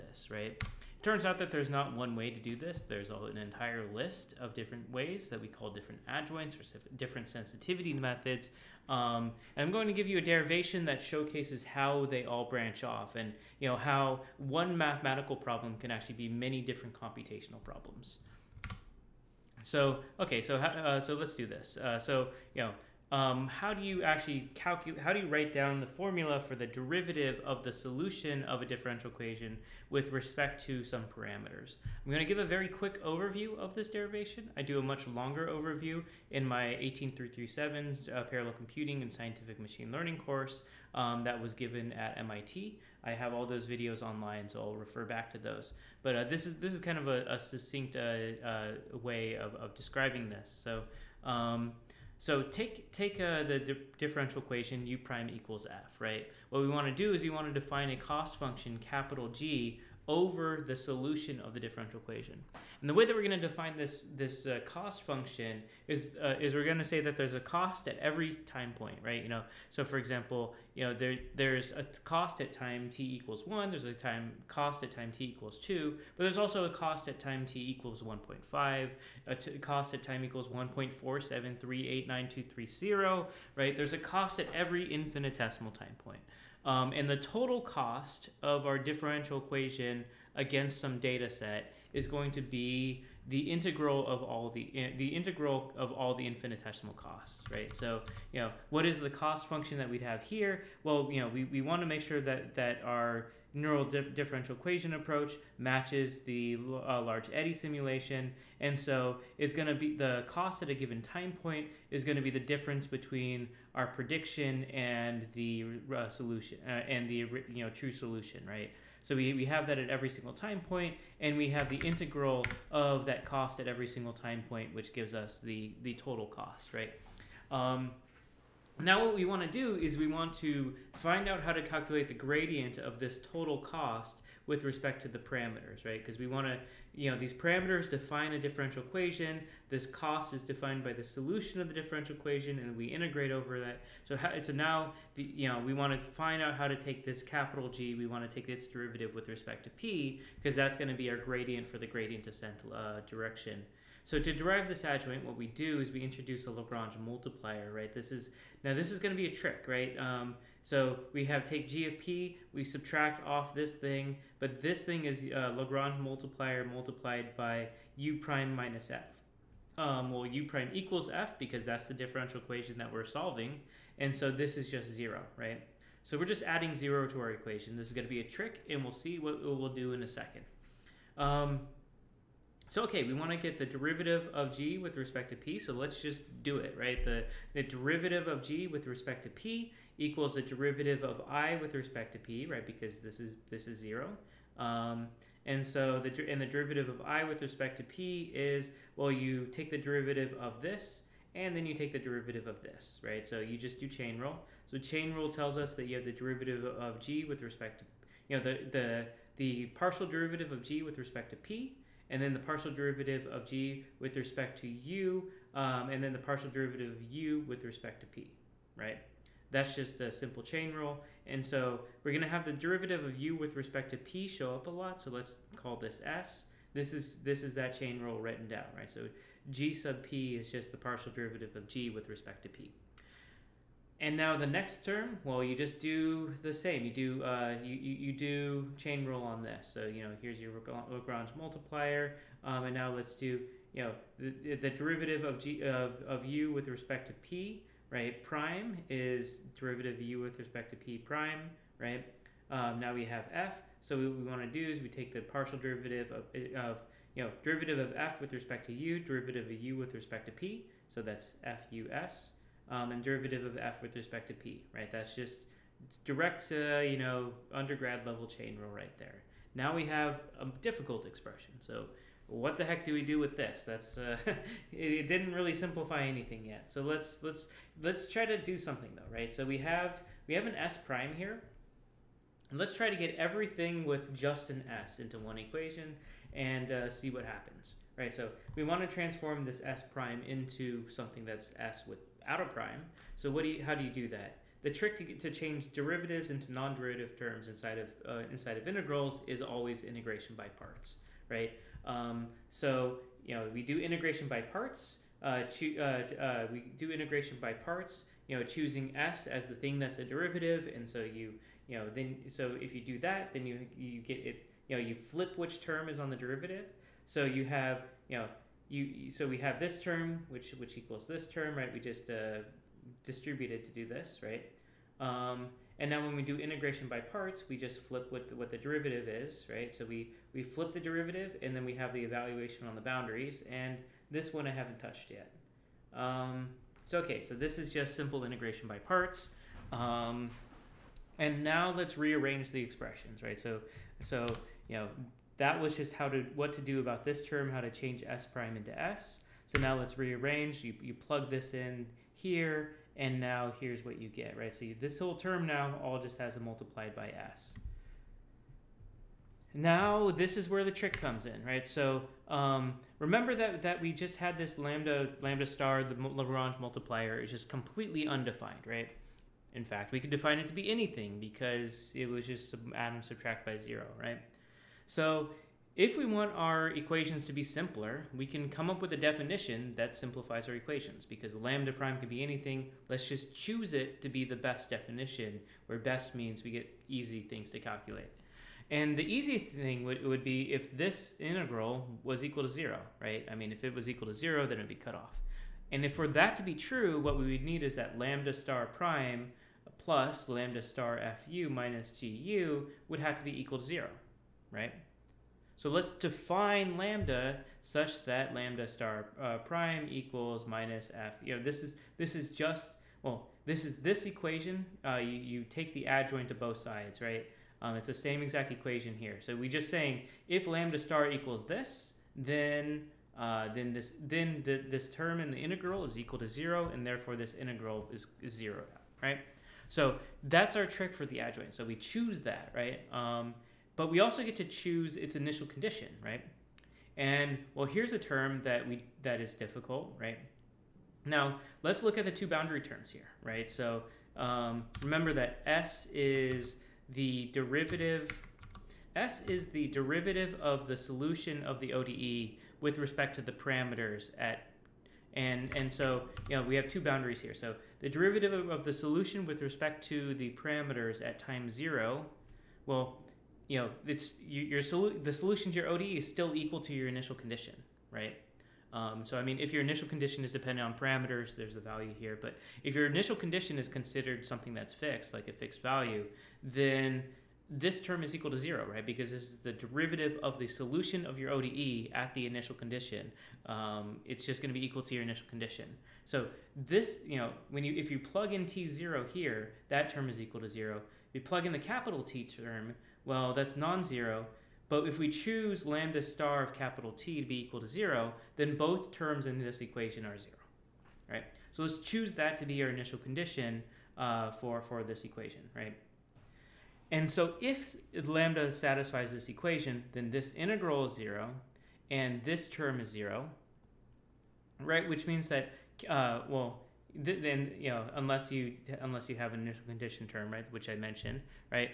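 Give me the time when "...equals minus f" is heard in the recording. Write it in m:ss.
6:49.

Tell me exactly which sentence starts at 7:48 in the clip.
Um, so I mean, if your initial condition is dependent on parameters, there's a value here.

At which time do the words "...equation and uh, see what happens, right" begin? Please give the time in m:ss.
4:45.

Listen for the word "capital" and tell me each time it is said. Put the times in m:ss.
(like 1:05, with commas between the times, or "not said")
0:58, 2:27, 8:11, 8:16.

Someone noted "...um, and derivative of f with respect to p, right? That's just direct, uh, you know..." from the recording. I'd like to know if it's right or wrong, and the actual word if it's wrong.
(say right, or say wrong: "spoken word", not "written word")
right.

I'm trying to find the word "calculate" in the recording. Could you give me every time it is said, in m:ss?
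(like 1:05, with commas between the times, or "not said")
0:24, 2:11, 6:27.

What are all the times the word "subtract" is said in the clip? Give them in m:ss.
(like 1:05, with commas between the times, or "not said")
2:42, 6:13.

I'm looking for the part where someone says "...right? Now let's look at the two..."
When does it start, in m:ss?
7:19.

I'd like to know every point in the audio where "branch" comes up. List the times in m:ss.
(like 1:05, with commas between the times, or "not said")
0:12.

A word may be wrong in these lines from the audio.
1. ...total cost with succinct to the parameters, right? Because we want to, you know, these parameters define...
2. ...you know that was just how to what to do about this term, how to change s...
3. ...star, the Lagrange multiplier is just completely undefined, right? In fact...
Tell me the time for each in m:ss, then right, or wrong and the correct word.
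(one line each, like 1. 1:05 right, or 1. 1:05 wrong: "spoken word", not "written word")
1. 2:13 wrong: "respect", not "succinct"
2. 5:44 right
3. 6:05 right.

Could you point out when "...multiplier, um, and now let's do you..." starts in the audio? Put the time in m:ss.
4:01.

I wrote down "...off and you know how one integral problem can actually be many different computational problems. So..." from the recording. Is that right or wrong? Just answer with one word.
wrong.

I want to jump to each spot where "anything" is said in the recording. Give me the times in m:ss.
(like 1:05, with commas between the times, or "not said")
4:36, 6:10, 6:22.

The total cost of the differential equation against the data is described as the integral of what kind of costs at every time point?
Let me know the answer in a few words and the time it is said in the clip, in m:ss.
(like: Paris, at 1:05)
infinitesimal costs, at 1:36.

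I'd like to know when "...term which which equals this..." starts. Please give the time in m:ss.
5:19.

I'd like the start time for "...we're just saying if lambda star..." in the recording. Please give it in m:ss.
6:59.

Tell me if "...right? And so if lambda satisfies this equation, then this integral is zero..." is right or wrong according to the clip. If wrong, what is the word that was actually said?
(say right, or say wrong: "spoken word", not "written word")
right.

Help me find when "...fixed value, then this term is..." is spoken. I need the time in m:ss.
7:55.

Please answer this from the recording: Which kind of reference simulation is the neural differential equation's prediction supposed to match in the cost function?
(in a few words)
large eddy simulation.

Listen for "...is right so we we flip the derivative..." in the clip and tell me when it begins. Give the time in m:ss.
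5:29.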